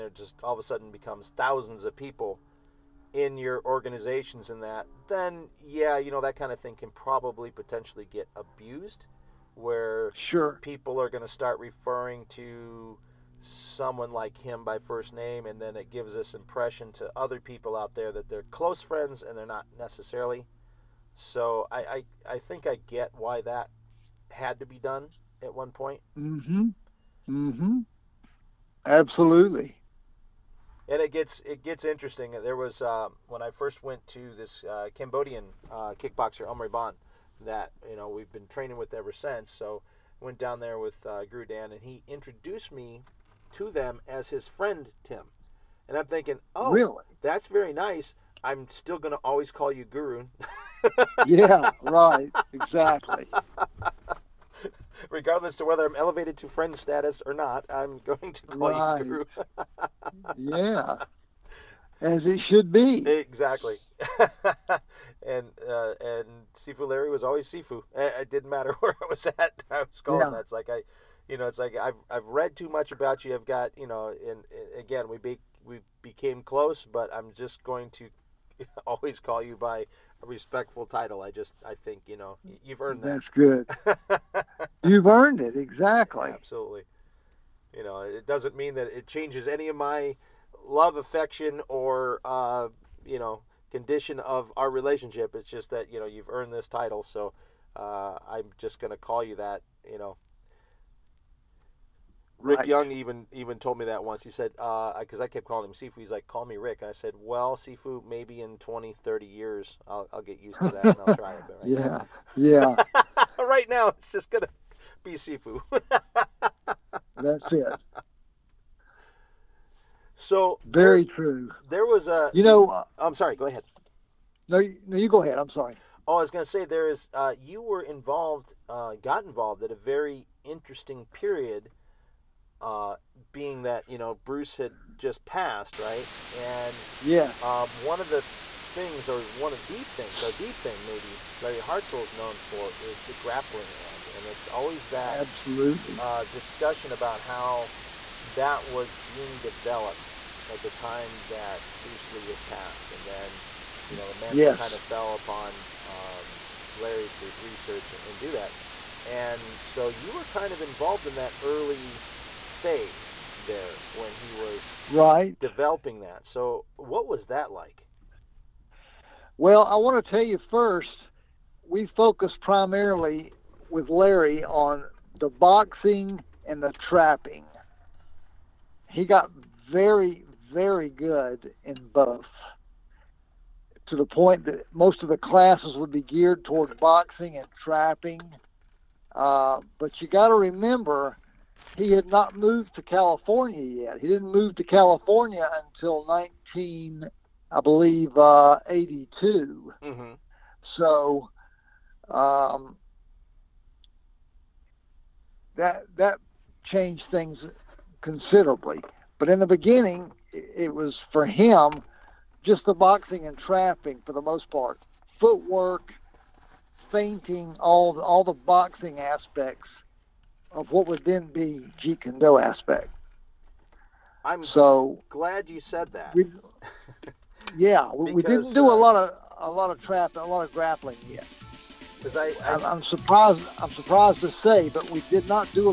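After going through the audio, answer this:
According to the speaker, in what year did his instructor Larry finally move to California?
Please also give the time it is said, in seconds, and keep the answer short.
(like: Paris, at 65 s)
1982, at 196 s.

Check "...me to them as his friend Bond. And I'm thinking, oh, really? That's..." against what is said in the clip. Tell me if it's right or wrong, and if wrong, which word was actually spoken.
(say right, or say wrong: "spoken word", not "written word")
wrong: "Tim", not "Bond".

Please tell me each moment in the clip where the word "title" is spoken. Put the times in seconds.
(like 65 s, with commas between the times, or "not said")
80 s, 96 s.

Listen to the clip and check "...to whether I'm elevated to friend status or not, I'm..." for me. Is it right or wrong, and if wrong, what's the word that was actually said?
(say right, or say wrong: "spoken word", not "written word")
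right.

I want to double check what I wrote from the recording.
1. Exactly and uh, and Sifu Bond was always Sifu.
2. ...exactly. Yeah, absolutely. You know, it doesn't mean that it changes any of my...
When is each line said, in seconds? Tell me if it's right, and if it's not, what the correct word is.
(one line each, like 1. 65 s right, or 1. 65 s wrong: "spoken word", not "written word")
1. 63 s wrong: "Larry", not "Bond"
2. 85 s right.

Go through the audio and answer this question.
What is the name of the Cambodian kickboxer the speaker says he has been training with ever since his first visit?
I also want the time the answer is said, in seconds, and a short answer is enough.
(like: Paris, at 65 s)
Omri Bond, at 36 s.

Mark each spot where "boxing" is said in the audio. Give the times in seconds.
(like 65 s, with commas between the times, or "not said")
175 s, 186 s, 212 s, 218 s.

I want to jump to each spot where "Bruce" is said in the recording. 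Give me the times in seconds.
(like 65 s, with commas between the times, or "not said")
134 s, 151 s.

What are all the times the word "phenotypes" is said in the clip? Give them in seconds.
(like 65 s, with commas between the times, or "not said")
not said.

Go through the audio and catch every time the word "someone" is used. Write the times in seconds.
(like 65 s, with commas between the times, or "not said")
13 s.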